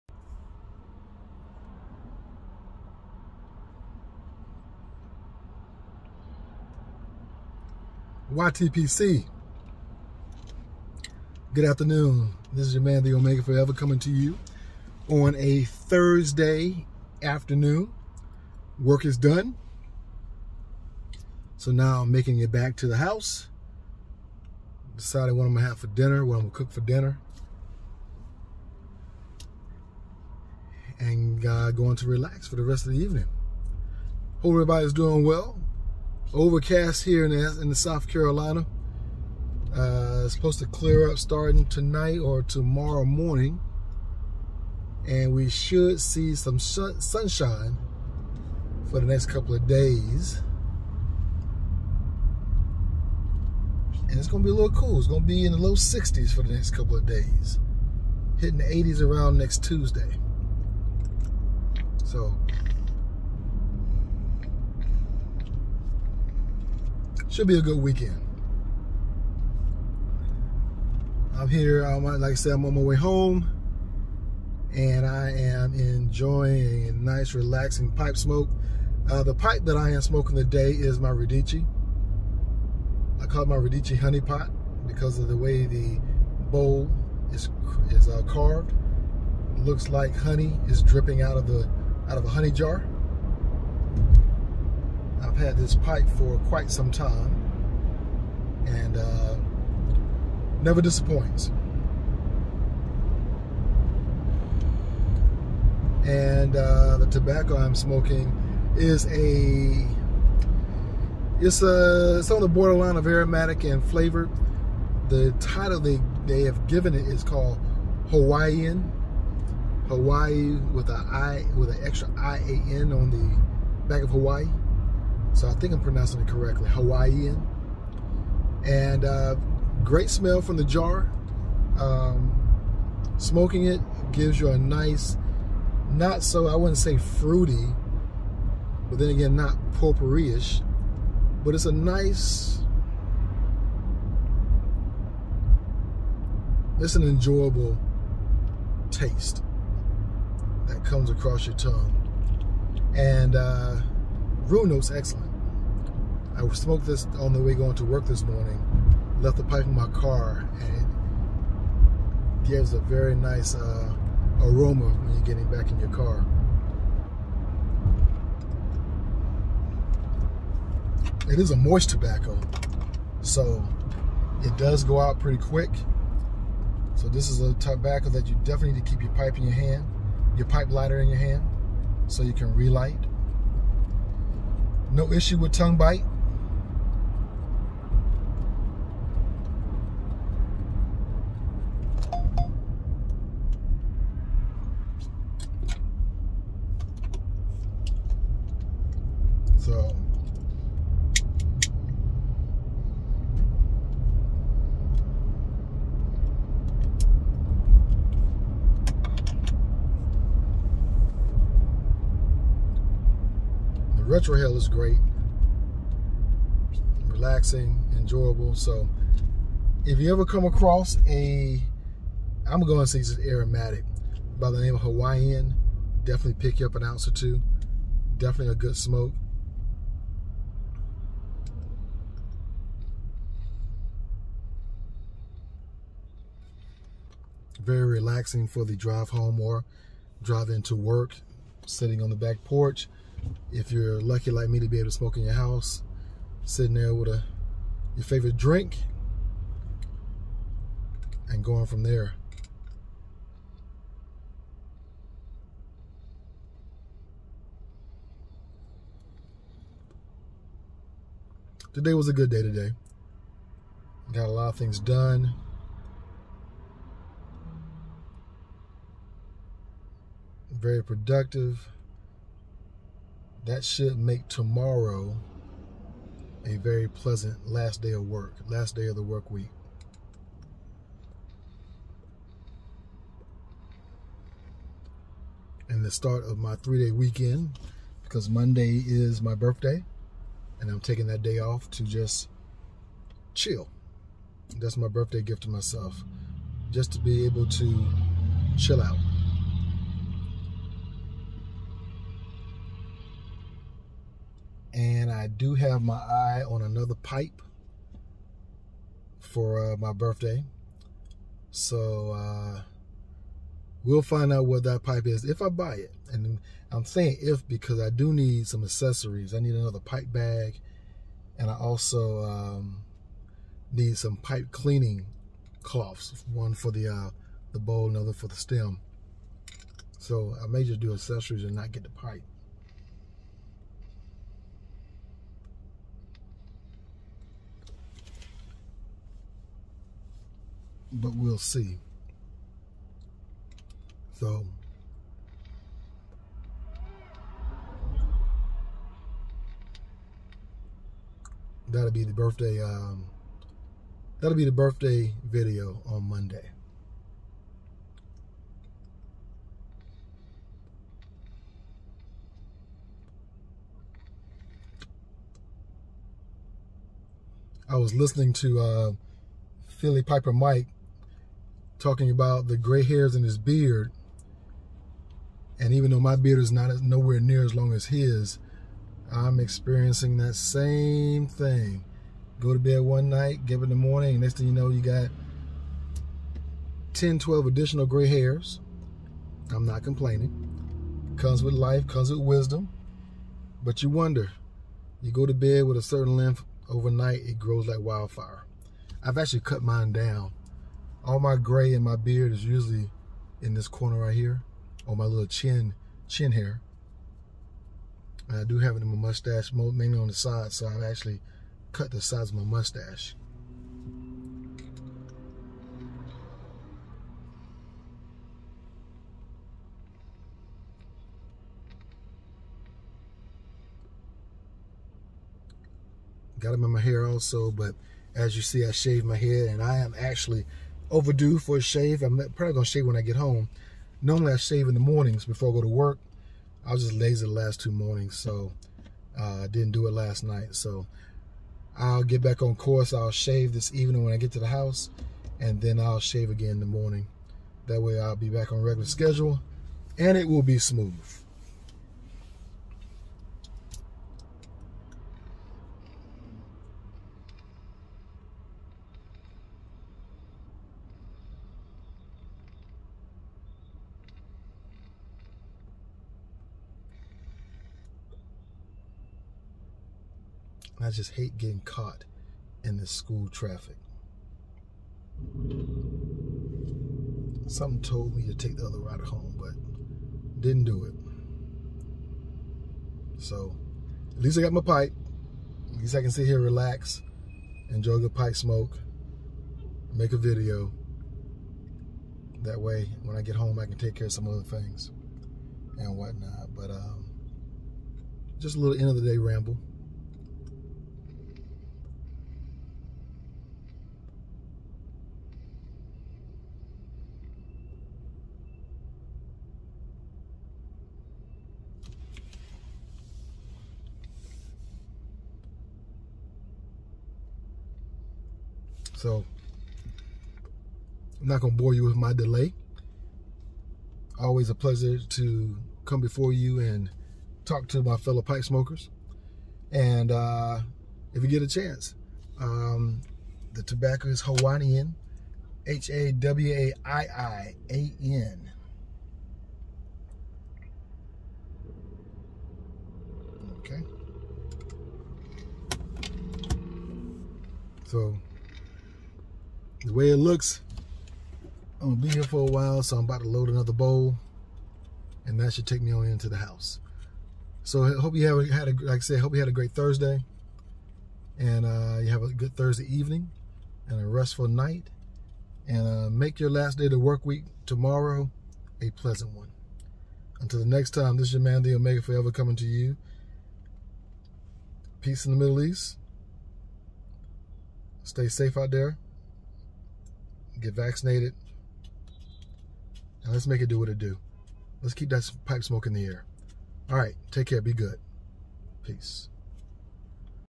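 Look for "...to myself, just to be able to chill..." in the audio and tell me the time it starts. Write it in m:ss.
4:55.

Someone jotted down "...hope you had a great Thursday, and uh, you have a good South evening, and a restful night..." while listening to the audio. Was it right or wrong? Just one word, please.
wrong.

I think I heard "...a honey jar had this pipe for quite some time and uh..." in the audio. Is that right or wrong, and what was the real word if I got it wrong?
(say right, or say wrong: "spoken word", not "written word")
right.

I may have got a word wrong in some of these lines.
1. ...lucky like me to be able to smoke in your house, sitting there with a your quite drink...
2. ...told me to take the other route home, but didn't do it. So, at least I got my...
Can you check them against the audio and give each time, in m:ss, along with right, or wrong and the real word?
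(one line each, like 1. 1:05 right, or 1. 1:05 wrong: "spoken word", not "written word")
1. 4:03 wrong: "favorite", not "quite"
2. 7:57 right.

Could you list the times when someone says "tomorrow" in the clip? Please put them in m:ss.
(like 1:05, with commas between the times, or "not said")
0:42, 4:34, 9:27.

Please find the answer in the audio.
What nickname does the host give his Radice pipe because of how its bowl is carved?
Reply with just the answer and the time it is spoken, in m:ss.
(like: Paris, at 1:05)
Honey Pot, at 1:23.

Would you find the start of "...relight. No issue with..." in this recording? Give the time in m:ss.
3:02.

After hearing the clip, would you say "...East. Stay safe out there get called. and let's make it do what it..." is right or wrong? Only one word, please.
wrong.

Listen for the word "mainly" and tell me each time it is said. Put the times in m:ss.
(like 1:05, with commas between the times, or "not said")
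6:49.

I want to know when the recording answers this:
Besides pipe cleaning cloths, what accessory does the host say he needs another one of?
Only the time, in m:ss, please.
5:19.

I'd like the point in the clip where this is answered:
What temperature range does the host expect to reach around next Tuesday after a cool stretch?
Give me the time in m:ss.
0:58.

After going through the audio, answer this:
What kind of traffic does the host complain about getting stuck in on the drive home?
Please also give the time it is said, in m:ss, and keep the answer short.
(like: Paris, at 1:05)
school traffic, at 7:52.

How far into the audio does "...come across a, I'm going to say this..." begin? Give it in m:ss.
3:40.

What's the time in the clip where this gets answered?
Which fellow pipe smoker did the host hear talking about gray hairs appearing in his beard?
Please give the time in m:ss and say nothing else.
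6:09.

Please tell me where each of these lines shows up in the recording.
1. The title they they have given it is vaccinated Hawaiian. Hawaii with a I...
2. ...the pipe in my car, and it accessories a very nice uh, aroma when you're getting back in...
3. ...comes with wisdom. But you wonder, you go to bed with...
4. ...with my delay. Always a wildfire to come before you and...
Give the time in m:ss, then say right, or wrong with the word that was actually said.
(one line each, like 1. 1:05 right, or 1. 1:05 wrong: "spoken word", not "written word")
1. 1:55 wrong: "called", not "vaccinated"
2. 2:39 wrong: "gives", not "accessories"
3. 6:31 right
4. 8:41 wrong: "pleasure", not "wildfire".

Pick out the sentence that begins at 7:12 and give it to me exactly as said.
I'm probably gonna shave when I get home.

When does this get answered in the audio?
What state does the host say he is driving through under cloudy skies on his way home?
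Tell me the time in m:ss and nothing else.
0:37.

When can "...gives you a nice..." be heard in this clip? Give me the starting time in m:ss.
2:14.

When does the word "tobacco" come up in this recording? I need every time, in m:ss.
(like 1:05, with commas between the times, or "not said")
1:47, 2:51, 2:57, 8:53.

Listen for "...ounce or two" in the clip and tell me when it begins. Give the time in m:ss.
3:46.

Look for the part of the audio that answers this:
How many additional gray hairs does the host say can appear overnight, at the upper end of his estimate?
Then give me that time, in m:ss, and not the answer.
6:27.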